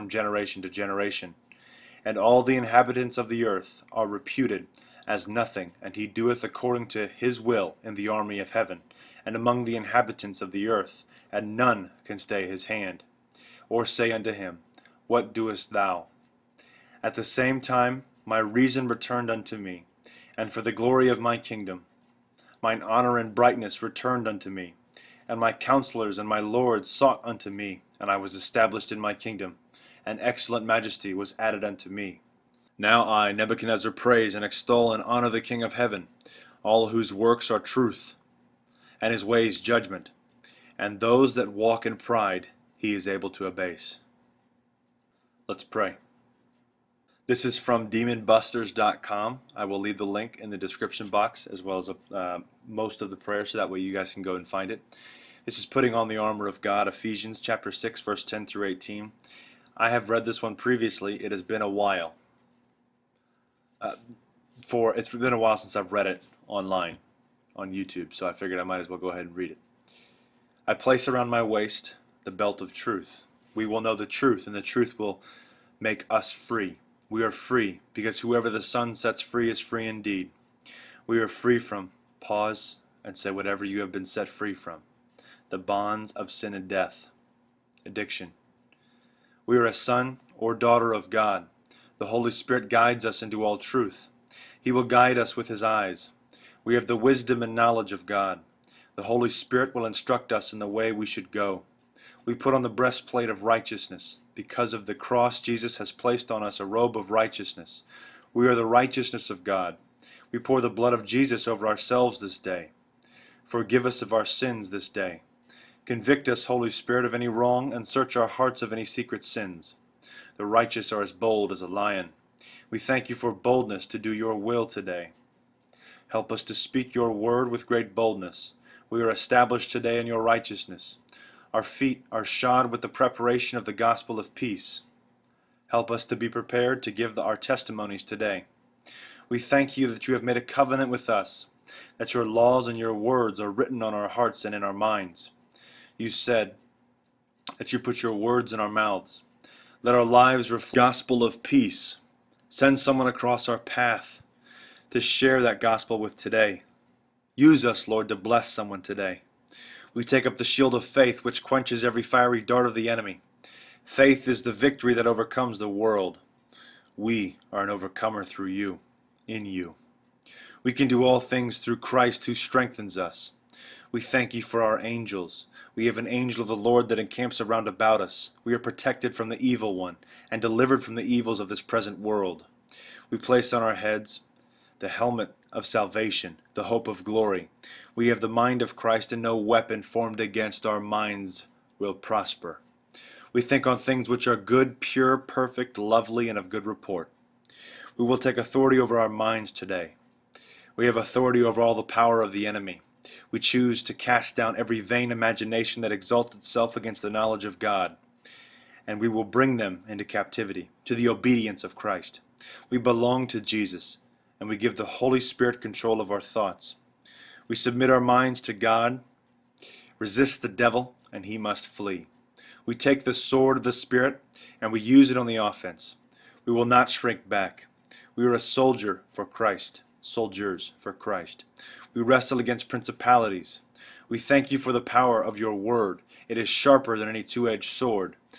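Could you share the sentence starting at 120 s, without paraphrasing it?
The righteous are as bold as a lion.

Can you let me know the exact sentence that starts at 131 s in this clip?
Our feet are shod with the preparation of the gospel of peace.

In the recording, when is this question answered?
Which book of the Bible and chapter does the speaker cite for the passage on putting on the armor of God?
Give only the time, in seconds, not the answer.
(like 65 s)
56 s.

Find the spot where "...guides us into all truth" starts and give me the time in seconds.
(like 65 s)
92 s.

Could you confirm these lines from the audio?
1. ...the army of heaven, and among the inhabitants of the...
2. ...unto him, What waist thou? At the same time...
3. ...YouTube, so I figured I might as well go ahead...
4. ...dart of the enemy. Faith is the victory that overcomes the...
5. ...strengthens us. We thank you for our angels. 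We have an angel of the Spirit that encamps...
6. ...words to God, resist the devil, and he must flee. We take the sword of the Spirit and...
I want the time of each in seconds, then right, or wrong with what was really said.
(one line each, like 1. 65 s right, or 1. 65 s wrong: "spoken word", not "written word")
1. 7 s right
2. 14 s wrong: "doest", not "waist"
3. 67 s right
4. 162 s right
5. 172 s wrong: "Lord", not "Spirit"
6. 217 s wrong: "minds", not "words".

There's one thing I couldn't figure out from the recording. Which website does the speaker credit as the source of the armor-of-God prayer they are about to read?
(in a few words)
demonbusters.com.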